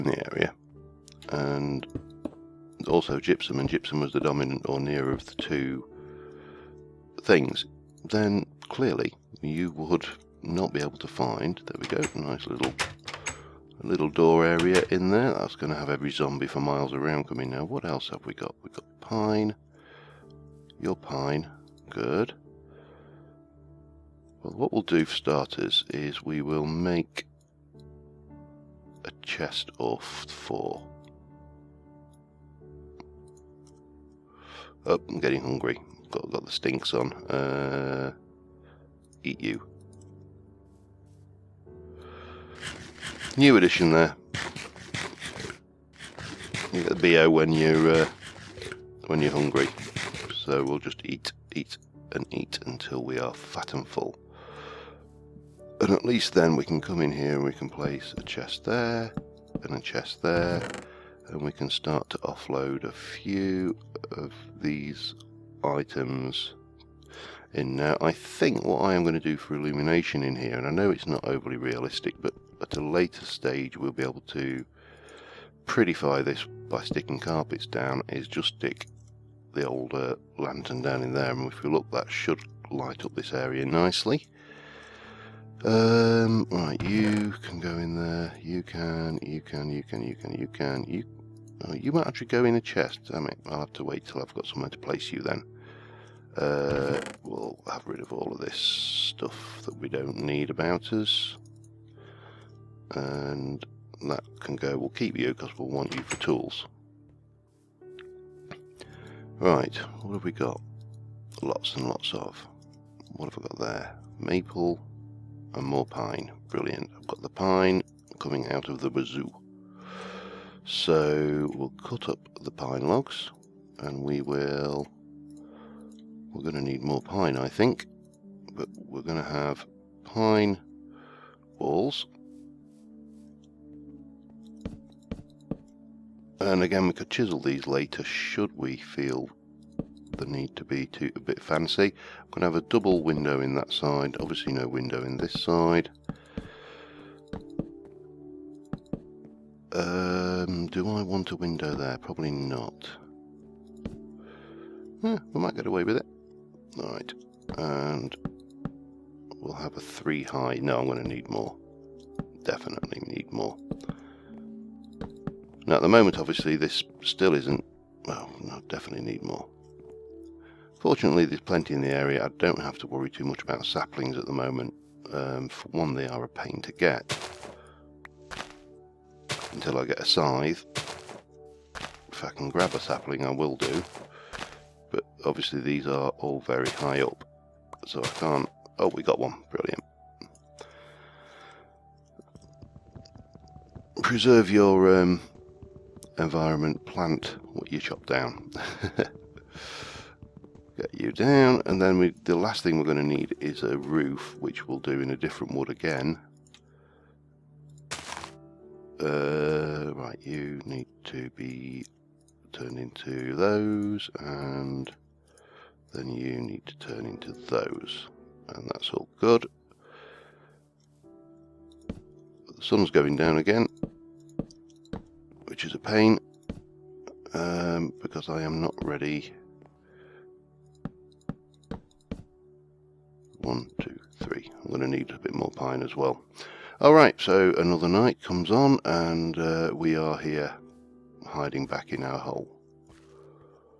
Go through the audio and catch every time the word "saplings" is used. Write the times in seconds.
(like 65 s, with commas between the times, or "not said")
173 s, 182 s.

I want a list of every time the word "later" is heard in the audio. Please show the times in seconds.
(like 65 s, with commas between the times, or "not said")
72 s, 137 s.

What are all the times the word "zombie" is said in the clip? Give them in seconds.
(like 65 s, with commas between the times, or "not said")
16 s.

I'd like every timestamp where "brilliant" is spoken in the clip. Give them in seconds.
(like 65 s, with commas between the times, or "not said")
116 s, 189 s.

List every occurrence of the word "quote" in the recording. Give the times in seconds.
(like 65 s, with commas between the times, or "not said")
not said.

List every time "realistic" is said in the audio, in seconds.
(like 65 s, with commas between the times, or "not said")
71 s.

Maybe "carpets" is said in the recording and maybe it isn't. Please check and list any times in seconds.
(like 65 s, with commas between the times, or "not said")
77 s.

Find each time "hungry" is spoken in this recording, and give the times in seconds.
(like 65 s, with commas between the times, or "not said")
35 s, 49 s.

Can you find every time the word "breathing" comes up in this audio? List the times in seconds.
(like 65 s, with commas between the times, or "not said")
not said.